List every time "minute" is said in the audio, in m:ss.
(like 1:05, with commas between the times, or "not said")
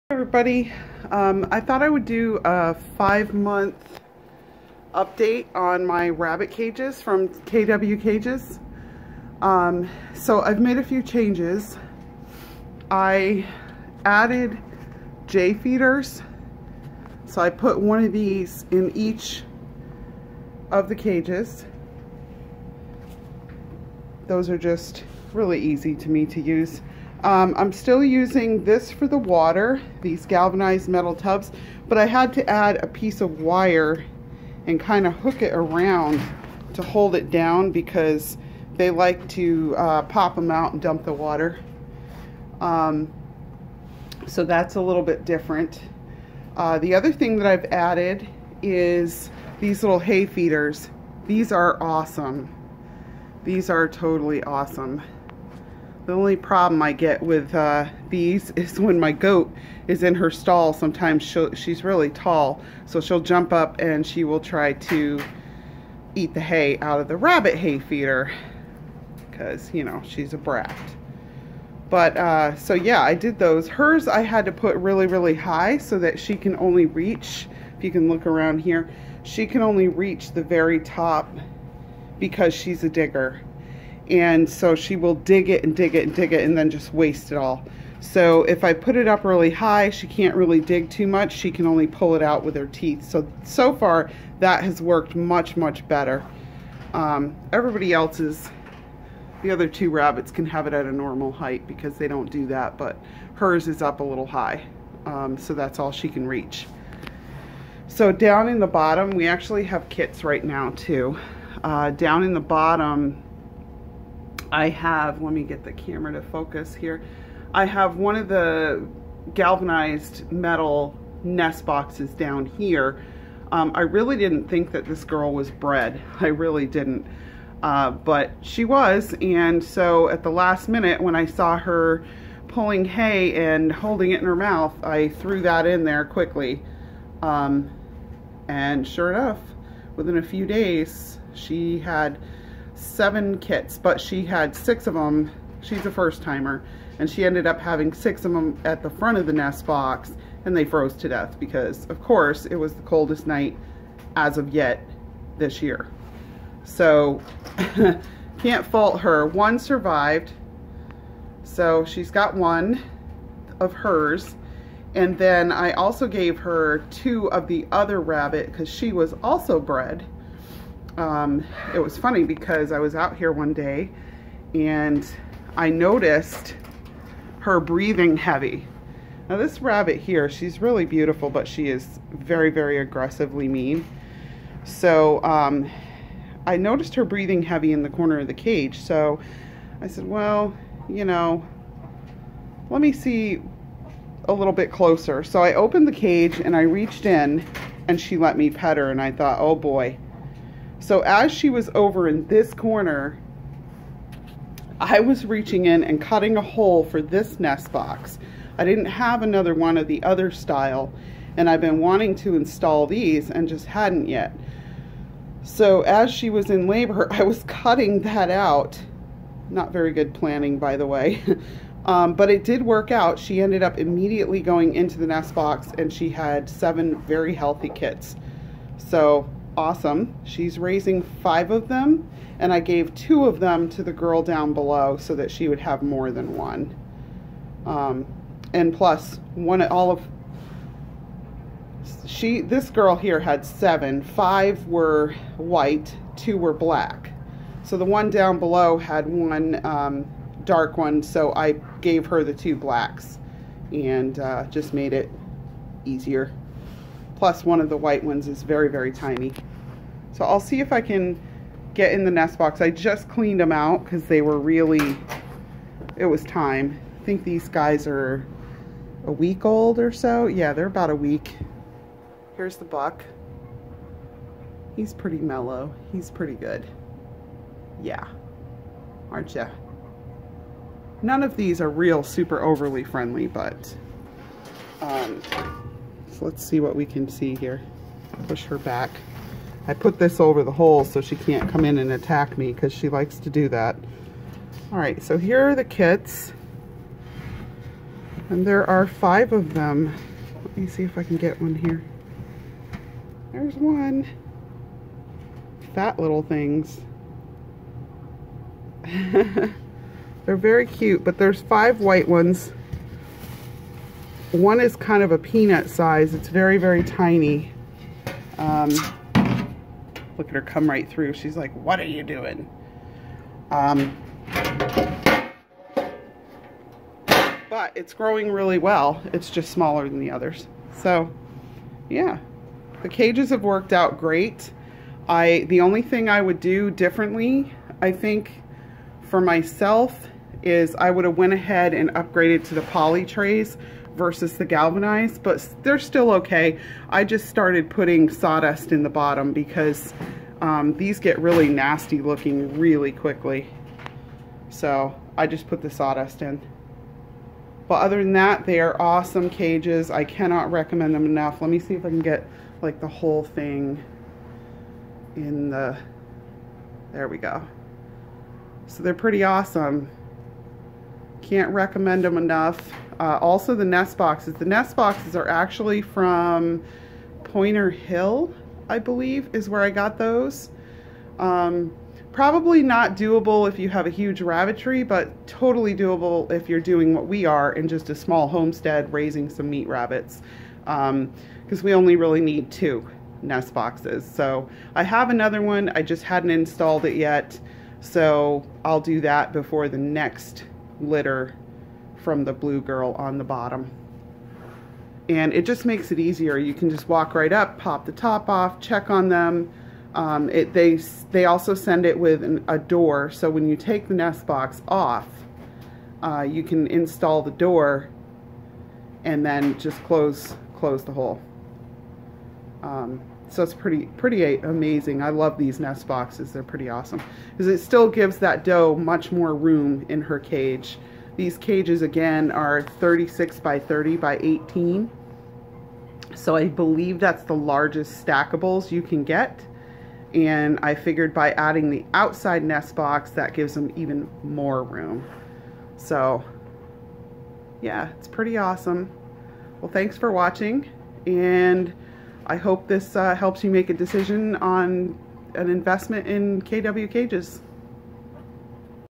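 2:10.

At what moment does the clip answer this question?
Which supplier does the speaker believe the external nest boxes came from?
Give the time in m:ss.
6:17.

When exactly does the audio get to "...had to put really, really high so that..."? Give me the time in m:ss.
1:14.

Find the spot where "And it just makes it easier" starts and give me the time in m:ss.
6:45.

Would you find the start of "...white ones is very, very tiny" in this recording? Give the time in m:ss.
4:17.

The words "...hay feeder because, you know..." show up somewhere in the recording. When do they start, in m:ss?
1:07.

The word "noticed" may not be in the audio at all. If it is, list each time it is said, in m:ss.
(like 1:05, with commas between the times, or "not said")
2:55, 3:06.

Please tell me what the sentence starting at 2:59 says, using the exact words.
Now this rabbit here, she's really beautiful, but she is very, very aggressively mean.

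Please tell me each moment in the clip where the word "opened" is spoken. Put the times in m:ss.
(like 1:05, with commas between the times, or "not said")
3:15.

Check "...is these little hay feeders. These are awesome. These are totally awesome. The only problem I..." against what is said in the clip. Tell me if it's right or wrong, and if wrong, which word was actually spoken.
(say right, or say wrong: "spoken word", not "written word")
right.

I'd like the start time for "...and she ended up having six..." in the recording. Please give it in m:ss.
2:26.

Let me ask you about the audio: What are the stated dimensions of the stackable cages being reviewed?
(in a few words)
36 by 30 by 18.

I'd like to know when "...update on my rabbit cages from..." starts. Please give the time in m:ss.
0:04.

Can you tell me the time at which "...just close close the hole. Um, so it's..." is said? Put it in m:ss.
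6:59.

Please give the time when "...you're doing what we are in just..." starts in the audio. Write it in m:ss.
6:26.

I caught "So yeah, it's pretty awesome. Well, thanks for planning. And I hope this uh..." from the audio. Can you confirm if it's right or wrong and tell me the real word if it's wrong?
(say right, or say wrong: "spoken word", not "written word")
wrong: "watching", not "planning".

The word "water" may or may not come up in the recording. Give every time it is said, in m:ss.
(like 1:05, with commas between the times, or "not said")
0:29, 0:41.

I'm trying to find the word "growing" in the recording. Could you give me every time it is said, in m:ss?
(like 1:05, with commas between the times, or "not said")
5:27.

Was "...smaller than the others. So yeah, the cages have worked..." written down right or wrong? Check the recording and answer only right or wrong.
right.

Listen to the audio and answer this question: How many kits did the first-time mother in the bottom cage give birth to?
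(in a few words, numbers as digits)
7.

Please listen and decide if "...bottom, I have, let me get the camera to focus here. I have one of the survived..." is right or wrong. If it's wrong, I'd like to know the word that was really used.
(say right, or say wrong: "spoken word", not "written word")
wrong: "galvanized", not "survived".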